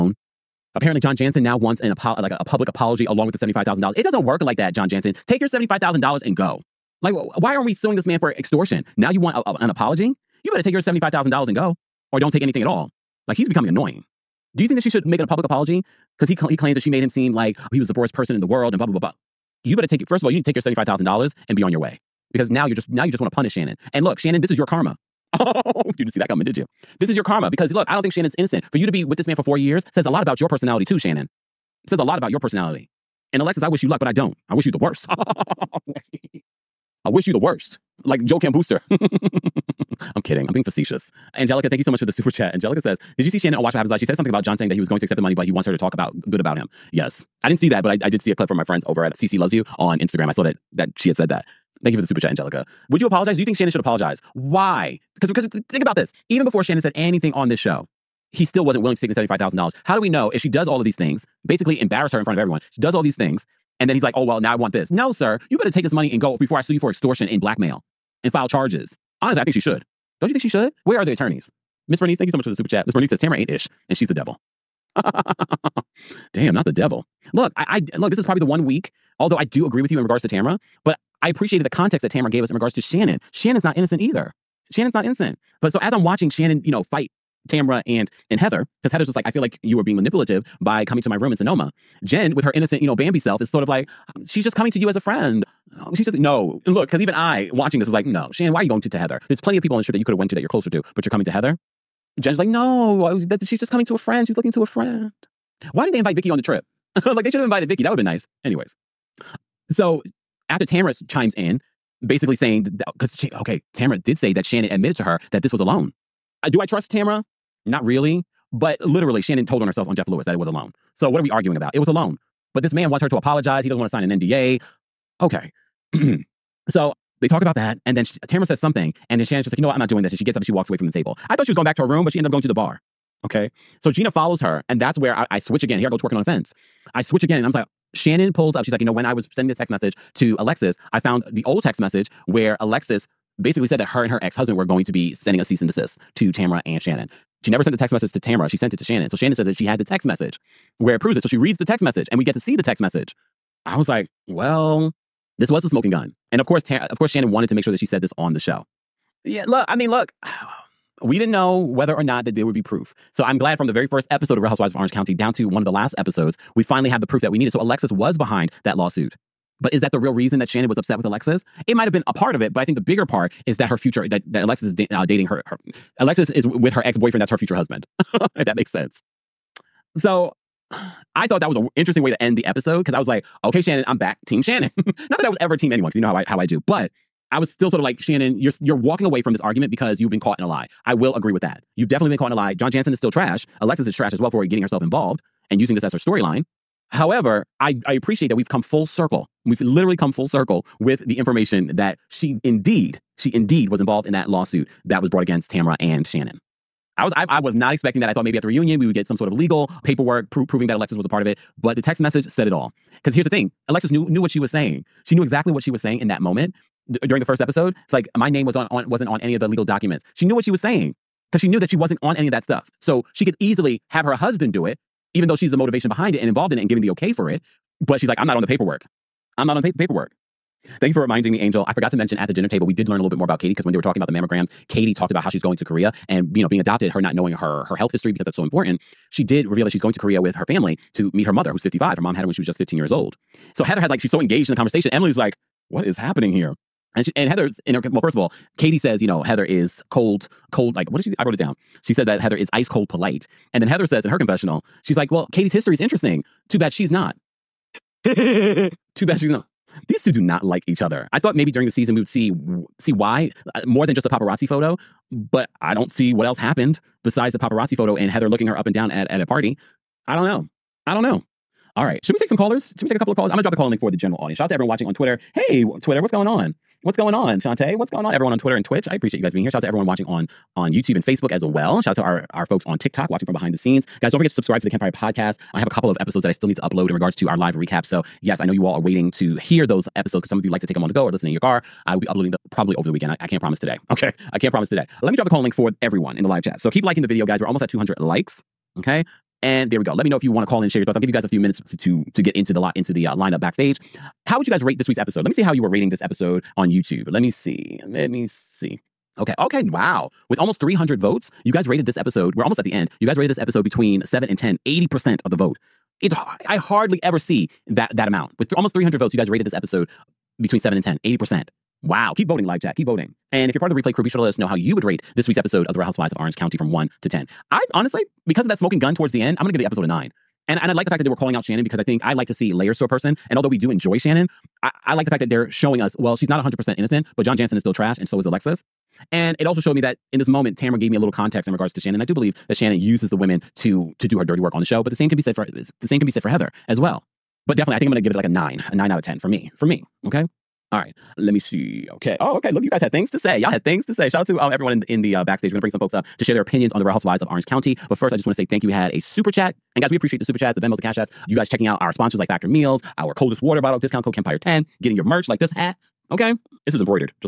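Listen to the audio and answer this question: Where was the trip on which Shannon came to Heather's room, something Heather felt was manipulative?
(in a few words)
Sonoma.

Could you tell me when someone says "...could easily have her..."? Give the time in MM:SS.
03:43.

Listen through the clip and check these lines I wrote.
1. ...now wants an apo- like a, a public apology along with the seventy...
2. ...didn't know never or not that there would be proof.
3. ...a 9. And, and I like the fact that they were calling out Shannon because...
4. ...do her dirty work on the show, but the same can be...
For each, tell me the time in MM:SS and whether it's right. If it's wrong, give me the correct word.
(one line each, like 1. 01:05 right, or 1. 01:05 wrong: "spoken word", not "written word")
1. 00:01 right
2. 02:41 wrong: "whether", not "never"
3. 05:29 right
4. 05:44 right.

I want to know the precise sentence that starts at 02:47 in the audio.
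So Alexis was behind that lawsuit.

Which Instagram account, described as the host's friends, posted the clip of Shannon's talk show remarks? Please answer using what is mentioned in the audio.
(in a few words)
CC Loves You.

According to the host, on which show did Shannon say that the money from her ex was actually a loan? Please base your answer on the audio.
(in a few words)
Jeff Lewis.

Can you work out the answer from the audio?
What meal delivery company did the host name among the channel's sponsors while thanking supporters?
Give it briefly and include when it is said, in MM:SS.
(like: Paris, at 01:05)
Factor Meals, at 06:02.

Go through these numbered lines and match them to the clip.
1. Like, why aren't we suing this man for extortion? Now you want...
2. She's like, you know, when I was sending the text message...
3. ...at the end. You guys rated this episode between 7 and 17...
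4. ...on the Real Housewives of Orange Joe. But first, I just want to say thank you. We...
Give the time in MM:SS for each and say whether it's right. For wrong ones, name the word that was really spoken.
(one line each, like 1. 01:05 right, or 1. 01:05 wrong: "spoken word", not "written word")
1. 00:07 right
2. 02:18 right
3. 05:12 wrong: "10", not "17"
4. 05:56 wrong: "County", not "Joe".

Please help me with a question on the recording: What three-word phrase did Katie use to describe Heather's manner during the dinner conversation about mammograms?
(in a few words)
ice cold polite.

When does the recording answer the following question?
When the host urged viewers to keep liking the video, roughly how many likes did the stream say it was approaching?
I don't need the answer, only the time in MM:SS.
04:57.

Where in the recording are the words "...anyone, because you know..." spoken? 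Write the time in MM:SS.
03:05.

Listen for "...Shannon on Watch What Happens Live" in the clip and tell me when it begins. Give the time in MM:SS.
00:43.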